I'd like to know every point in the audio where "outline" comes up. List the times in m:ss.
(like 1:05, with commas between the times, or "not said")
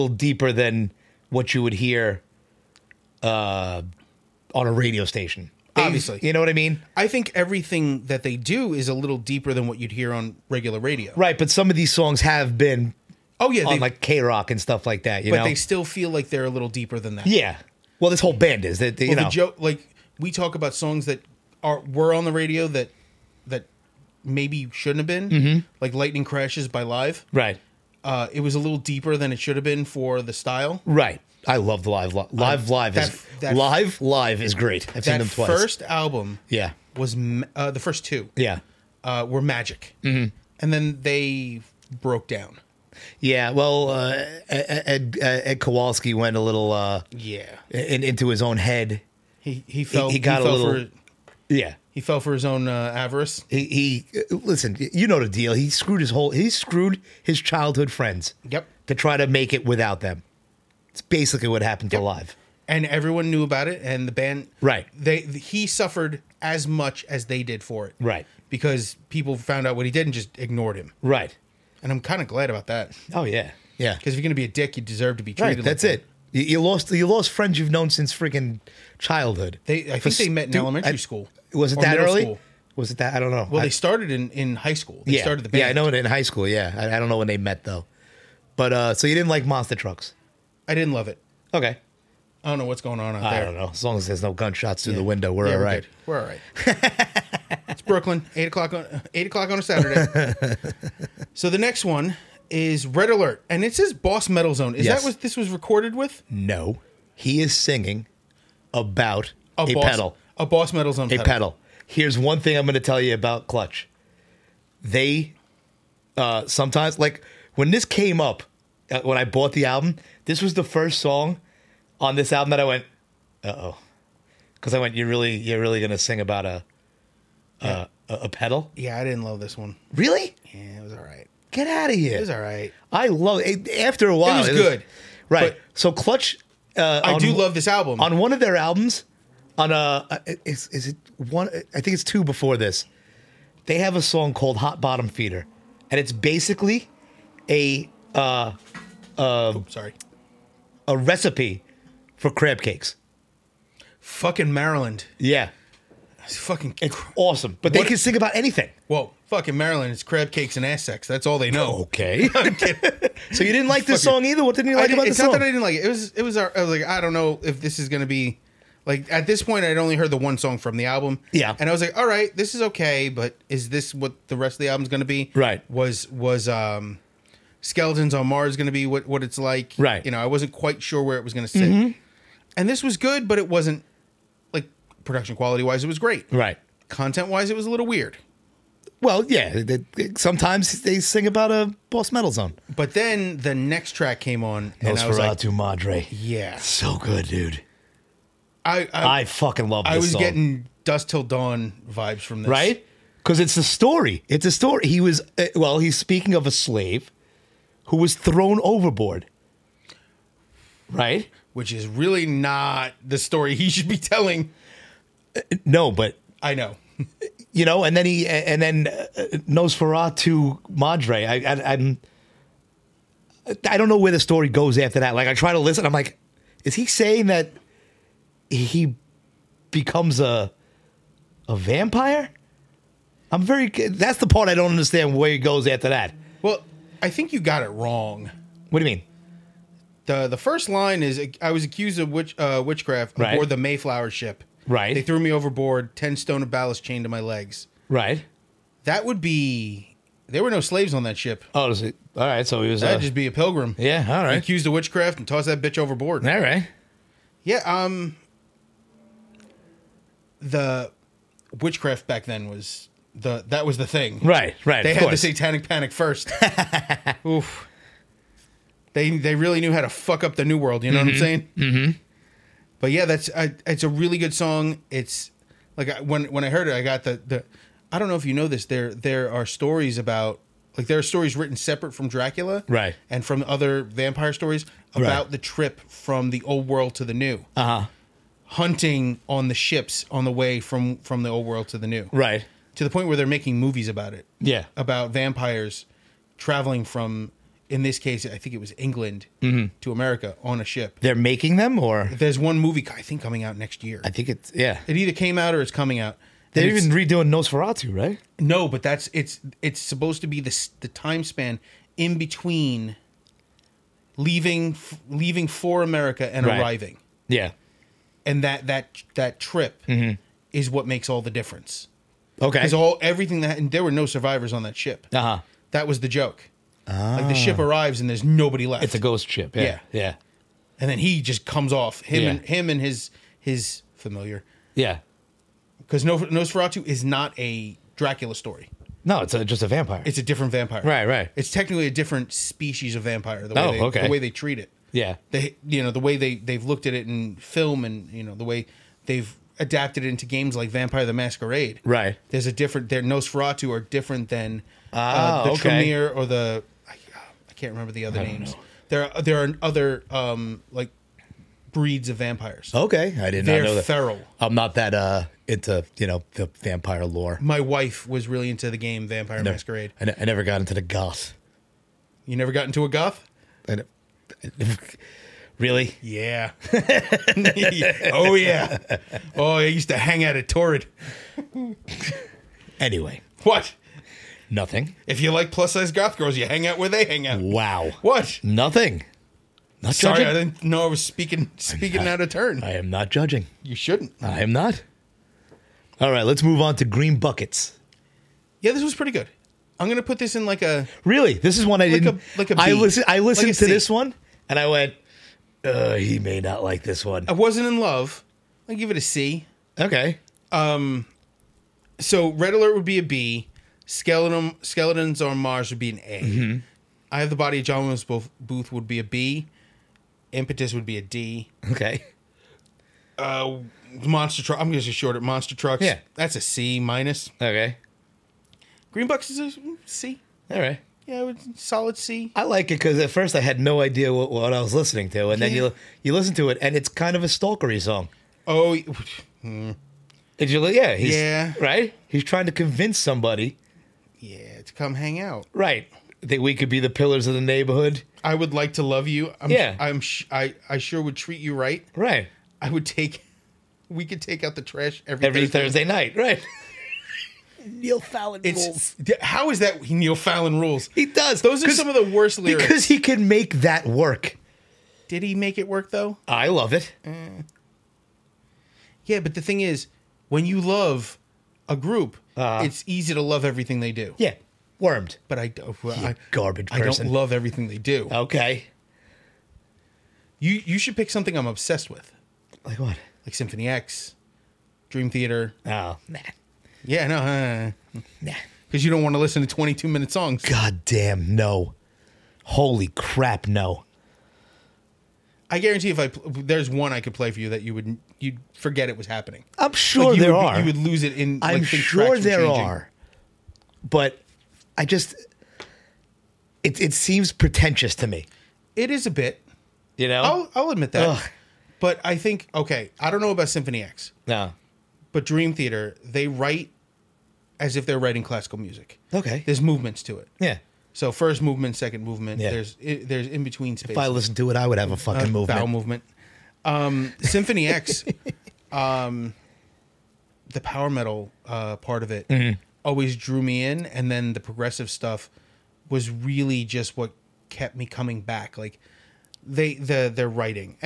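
not said.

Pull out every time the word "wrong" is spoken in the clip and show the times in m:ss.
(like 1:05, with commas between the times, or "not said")
3:57.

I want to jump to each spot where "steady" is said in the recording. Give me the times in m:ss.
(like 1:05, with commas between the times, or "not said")
not said.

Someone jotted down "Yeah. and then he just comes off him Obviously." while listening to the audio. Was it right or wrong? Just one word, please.
wrong.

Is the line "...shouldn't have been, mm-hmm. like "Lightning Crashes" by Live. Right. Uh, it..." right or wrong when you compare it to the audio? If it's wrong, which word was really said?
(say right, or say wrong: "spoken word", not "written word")
right.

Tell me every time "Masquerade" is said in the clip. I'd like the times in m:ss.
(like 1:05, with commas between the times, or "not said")
5:51, 6:09.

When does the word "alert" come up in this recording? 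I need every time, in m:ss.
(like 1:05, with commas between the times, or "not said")
1:43, 6:52.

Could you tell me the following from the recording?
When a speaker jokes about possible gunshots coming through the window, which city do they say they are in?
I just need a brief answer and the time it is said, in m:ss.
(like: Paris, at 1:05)
Brooklyn, at 1:37.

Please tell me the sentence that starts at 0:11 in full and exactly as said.
Right, but some of these songs have been, oh yeah, on like K rock and stuff like that.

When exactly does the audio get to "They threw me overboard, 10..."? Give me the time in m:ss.
4:04.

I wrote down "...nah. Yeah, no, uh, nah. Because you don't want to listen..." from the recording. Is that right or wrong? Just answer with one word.
right.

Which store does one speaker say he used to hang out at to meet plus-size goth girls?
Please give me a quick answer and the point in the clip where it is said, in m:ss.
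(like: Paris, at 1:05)
Torrid, at 6:20.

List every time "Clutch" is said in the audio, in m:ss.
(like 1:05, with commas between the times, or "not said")
1:53, 2:15.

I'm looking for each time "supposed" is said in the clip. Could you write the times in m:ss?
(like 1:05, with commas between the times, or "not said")
5:09.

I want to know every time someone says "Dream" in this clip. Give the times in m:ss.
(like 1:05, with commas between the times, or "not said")
8:04, 8:35.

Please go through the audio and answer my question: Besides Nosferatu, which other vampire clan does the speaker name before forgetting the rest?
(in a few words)
Tremere.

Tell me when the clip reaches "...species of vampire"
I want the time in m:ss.
5:42.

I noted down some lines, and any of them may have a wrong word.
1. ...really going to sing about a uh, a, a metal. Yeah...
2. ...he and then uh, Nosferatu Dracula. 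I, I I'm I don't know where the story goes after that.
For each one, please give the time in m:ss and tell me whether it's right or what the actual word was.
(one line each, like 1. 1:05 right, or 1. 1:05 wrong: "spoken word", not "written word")
1. 2:05 wrong: "pedal", not "metal"
2. 3:38 wrong: "Madre", not "Dracula".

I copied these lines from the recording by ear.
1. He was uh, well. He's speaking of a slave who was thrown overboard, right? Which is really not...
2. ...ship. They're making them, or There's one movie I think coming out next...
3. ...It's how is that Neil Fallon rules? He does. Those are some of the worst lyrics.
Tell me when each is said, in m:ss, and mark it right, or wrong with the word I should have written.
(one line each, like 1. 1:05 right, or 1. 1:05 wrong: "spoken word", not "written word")
1. 3:24 right
2. 5:00 right
3. 7:38 right.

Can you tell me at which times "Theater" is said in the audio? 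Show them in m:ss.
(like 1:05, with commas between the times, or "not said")
8:05, 8:35.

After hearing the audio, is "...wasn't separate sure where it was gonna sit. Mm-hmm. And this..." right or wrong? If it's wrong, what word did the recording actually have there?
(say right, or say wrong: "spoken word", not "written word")
wrong: "quite", not "separate".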